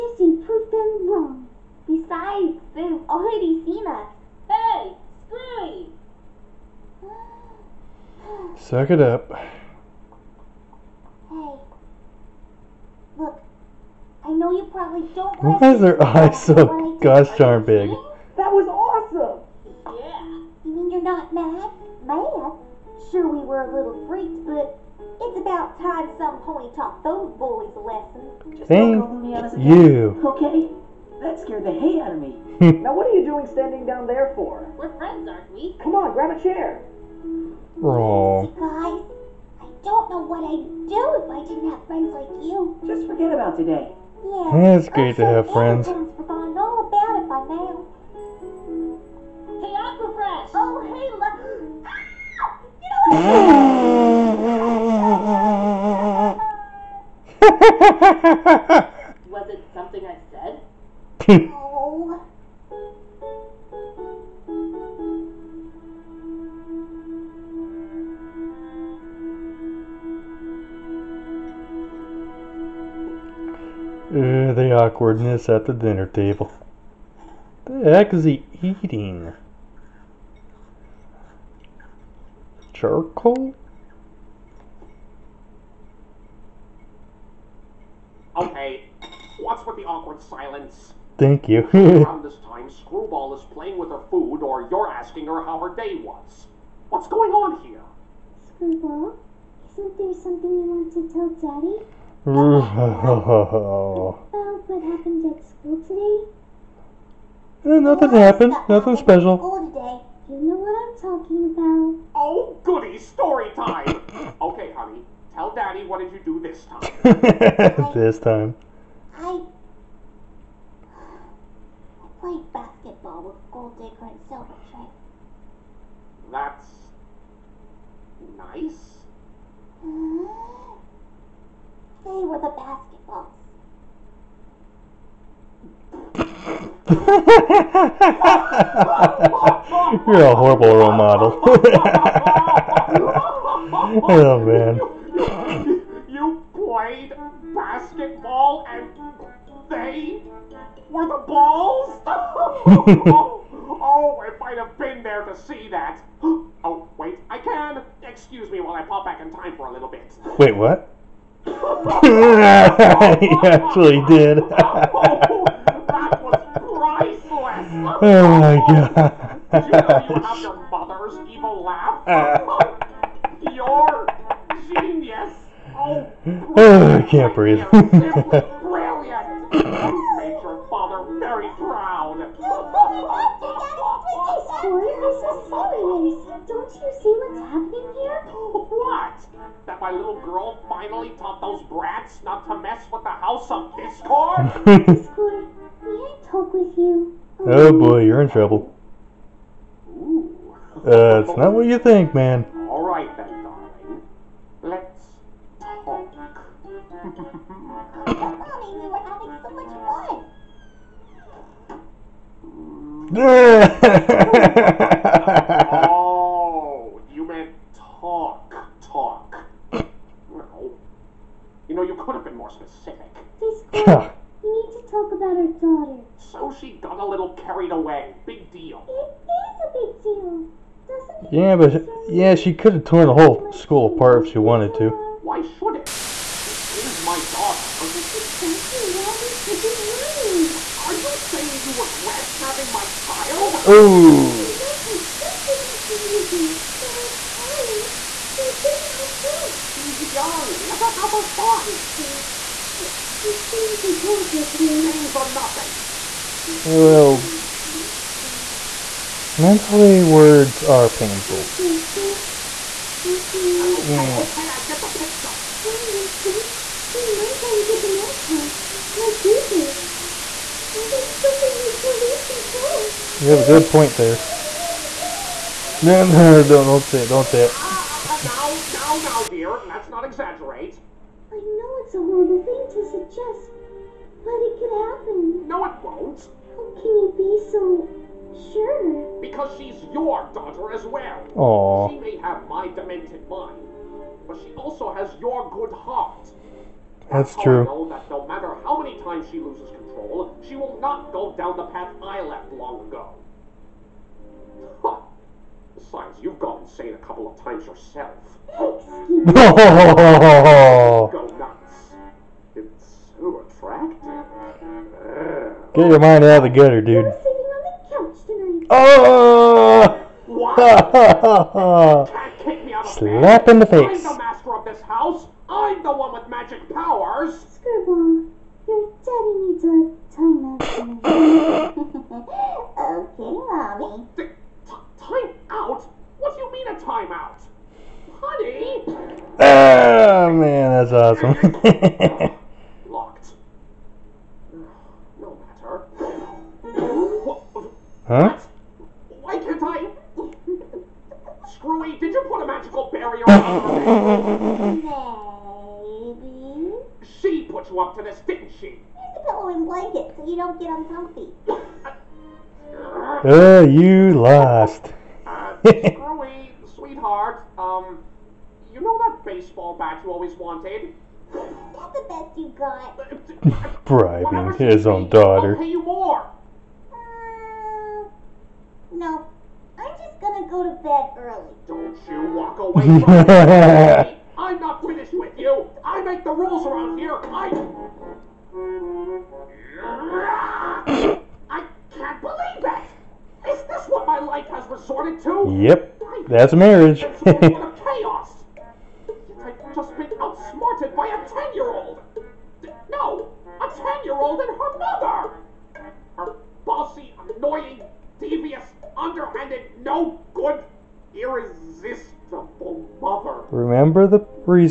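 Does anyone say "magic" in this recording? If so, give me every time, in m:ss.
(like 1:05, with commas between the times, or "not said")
5:26.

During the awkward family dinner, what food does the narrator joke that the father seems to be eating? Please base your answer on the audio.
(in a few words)
Charcoal.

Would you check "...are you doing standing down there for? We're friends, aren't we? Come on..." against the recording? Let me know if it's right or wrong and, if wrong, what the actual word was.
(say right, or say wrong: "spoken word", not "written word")
right.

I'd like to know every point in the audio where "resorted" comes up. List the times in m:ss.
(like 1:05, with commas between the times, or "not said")
6:34.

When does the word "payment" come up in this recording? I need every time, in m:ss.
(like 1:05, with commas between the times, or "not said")
not said.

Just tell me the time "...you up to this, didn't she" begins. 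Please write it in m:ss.
5:57.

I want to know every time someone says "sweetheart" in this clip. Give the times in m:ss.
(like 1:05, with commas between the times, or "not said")
6:06.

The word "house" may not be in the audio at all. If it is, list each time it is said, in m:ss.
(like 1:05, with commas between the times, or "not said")
3:13, 5:24.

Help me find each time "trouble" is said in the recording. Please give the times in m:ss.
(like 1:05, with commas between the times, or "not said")
3:18.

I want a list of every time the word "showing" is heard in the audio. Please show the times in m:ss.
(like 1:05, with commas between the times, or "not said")
not said.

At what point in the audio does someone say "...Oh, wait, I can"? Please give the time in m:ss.
2:36.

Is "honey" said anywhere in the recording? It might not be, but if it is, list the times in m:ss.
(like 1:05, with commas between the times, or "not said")
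1:54, 5:38.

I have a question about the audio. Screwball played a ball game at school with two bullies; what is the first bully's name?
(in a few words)
Gold Digger.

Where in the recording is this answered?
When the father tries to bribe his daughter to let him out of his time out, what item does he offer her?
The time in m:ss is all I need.
6:09.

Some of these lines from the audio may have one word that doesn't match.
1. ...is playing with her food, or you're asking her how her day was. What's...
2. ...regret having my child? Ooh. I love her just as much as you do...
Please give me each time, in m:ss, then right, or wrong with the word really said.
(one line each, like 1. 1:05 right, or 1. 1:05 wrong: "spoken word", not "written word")
1. 1:33 right
2. 4:01 right.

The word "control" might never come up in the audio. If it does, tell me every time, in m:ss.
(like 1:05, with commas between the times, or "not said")
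4:32, 4:59.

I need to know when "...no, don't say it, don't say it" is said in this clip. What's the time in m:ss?
4:36.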